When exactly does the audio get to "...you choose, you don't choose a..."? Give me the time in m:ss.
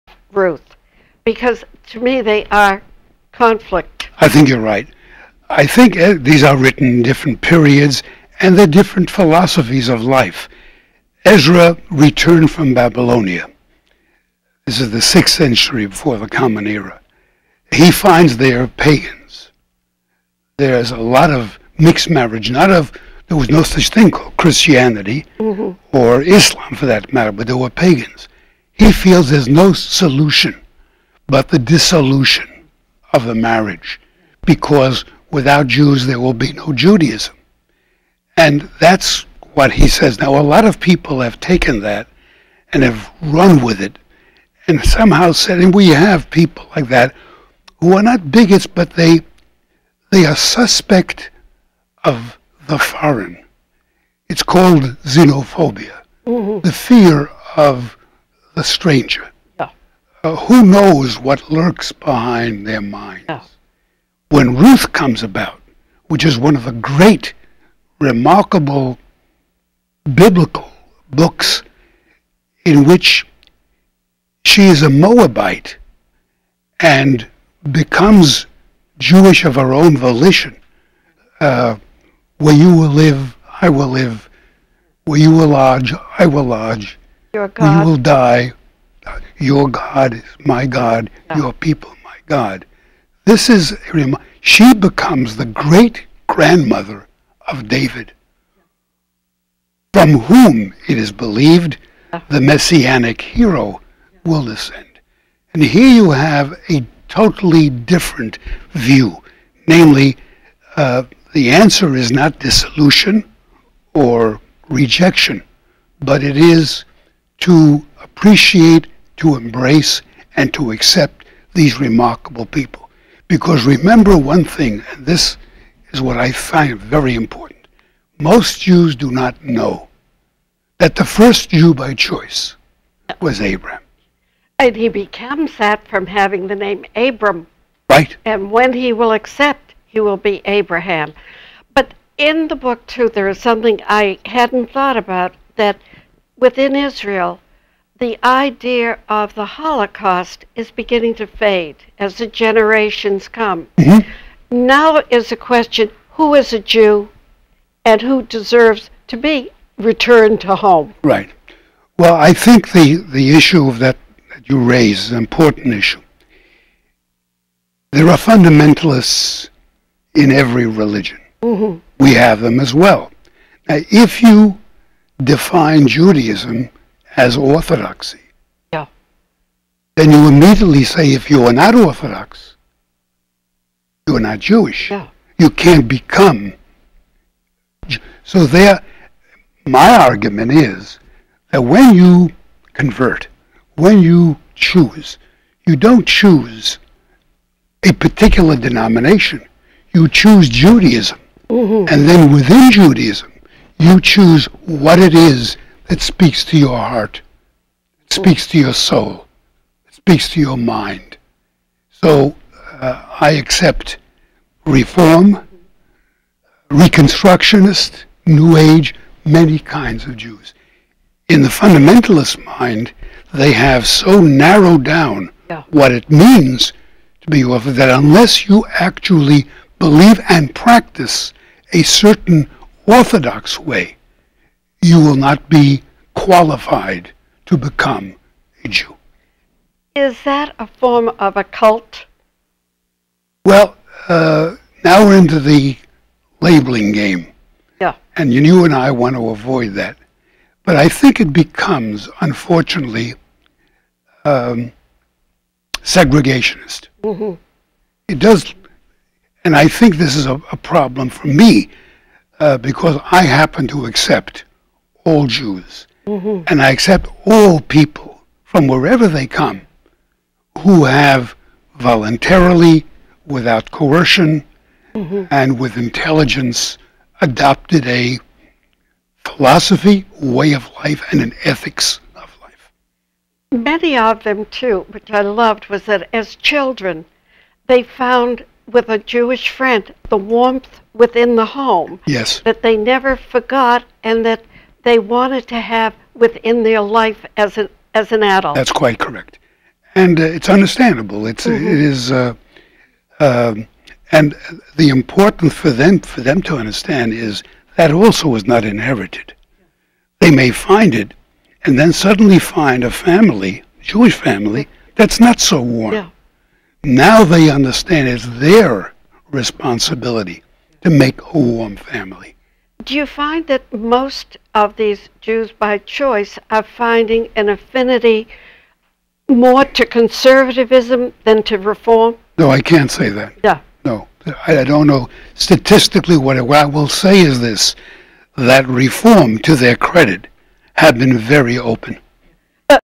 3:14.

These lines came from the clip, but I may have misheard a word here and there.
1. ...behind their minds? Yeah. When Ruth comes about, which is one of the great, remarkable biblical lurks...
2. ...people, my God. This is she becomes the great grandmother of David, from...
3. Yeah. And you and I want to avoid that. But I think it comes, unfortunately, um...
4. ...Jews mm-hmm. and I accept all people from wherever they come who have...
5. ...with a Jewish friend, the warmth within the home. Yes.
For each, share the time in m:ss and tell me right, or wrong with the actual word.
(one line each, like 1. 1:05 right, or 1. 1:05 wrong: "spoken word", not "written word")
1. 1:01 wrong: "books", not "lurks"
2. 1:31 right
3. 4:07 wrong: "becomes", not "comes"
4. 4:25 right
5. 4:48 right.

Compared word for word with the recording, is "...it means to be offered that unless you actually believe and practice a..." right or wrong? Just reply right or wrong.
right.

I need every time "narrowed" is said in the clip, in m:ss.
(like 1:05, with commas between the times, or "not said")
3:44.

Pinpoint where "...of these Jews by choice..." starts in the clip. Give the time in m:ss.
5:24.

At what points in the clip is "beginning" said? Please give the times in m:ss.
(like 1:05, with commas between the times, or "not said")
2:30.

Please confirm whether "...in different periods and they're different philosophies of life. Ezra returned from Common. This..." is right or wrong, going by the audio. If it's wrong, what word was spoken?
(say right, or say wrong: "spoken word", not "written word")
wrong: "Babylonia", not "Common".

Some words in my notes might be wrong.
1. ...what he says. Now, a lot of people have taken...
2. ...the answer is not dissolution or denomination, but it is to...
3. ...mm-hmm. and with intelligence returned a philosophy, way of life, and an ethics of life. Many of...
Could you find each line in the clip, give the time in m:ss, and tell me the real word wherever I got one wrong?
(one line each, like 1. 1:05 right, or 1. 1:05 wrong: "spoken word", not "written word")
1. 0:39 right
2. 1:51 wrong: "rejection", not "denomination"
3. 4:34 wrong: "adopted", not "returned".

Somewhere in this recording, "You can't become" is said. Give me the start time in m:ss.
3:05.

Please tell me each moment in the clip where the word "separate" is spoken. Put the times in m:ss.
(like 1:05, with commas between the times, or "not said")
not said.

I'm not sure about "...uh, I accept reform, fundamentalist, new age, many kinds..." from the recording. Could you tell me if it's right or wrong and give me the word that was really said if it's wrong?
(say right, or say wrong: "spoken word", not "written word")
wrong: "reconstructionist", not "fundamentalist".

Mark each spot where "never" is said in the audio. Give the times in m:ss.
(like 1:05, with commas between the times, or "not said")
4:52.